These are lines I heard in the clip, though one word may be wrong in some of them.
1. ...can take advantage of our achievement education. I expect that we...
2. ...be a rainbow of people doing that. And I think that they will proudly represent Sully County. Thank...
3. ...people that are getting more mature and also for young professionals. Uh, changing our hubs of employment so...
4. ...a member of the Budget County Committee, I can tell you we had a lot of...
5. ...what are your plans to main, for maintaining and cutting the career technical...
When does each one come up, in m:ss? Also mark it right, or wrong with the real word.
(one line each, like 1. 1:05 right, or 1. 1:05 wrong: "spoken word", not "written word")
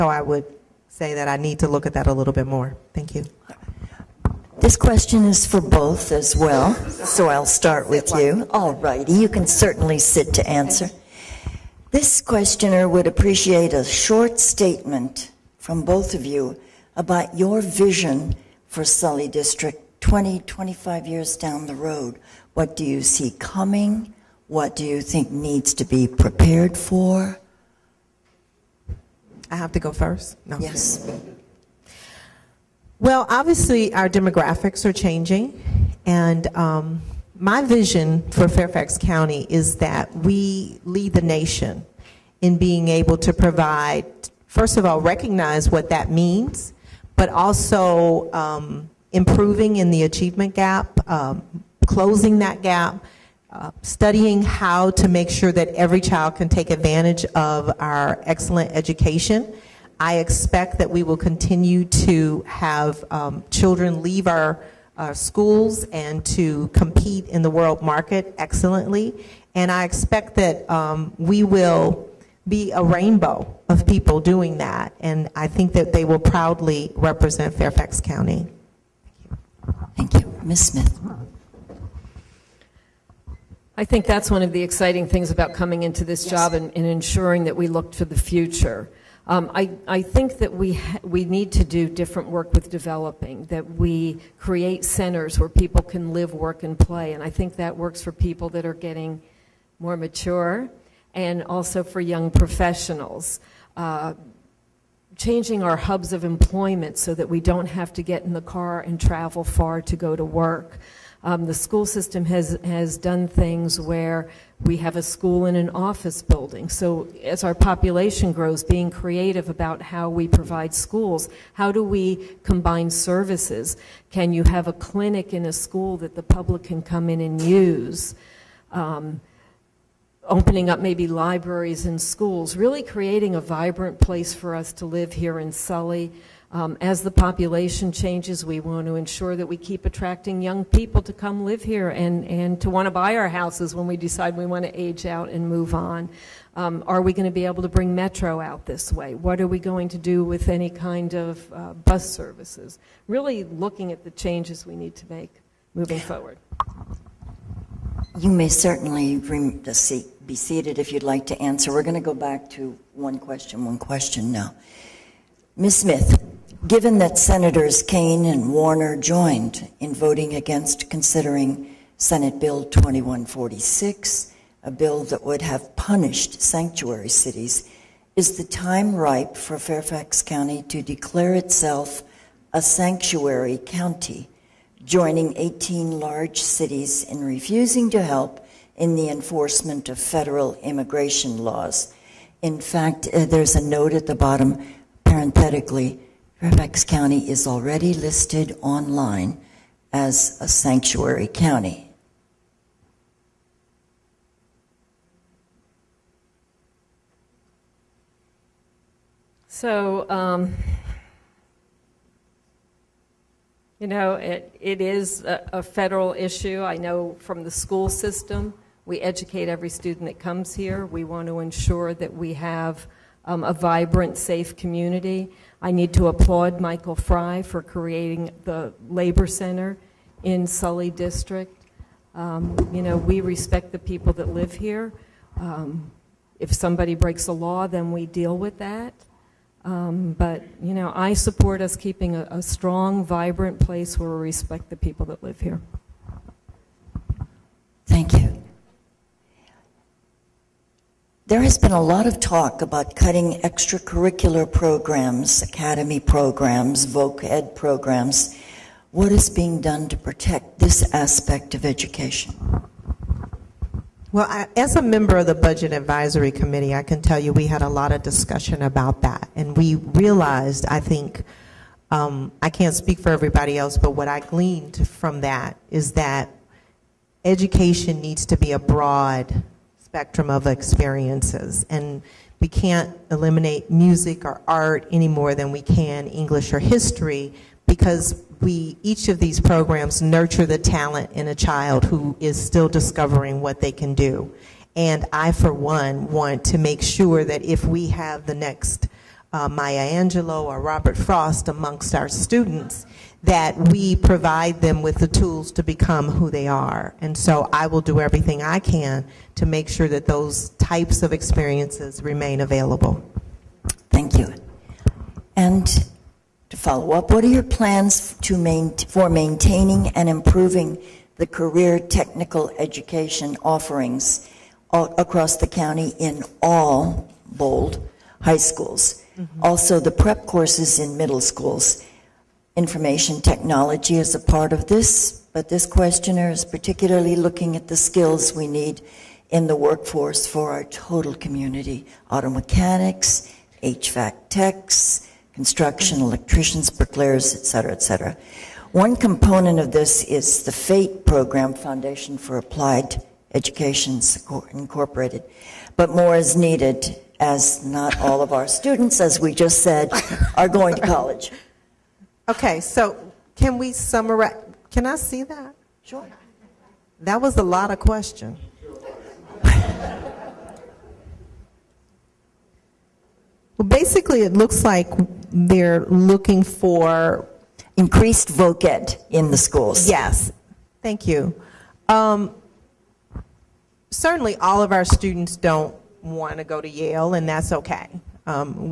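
1. 0:56 wrong: "excellent", not "achievement"
2. 1:12 wrong: "Fairfax", not "Sully"
3. 1:38 right
4. 4:24 wrong: "Advisory", not "County"
5. 5:17 wrong: "improving", not "cutting".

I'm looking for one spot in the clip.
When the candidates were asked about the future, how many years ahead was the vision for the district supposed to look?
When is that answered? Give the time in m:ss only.
0:20.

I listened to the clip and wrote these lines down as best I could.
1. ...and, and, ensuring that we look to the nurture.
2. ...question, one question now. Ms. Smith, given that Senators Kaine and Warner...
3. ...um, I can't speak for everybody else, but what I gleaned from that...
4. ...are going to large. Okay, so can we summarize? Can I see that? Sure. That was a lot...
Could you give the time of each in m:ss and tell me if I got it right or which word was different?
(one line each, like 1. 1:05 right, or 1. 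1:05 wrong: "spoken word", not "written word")
1. 1:26 wrong: "future", not "nurture"
2. 2:43 right
3. 4:31 right
4. 6:00 wrong: "college", not "large".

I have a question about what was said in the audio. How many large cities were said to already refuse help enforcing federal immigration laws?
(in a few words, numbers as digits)
18.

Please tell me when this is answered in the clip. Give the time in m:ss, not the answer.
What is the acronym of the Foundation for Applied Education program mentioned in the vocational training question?
5:50.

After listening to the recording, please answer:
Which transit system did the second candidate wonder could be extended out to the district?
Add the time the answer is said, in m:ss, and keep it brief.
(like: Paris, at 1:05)
Metro, at 2:27.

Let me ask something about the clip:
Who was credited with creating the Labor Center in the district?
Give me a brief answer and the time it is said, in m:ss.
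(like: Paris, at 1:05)
Michael Frey, at 3:46.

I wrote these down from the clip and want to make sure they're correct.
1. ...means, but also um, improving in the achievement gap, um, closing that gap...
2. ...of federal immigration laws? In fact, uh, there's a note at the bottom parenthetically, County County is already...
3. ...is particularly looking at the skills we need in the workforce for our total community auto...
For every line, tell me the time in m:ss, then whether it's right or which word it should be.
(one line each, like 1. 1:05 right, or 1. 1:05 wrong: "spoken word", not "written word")
1. 0:46 right
2. 3:09 wrong: "Fairfax", not "County"
3. 5:36 right.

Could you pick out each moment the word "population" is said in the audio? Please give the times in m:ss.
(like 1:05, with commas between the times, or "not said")
1:57, 2:17.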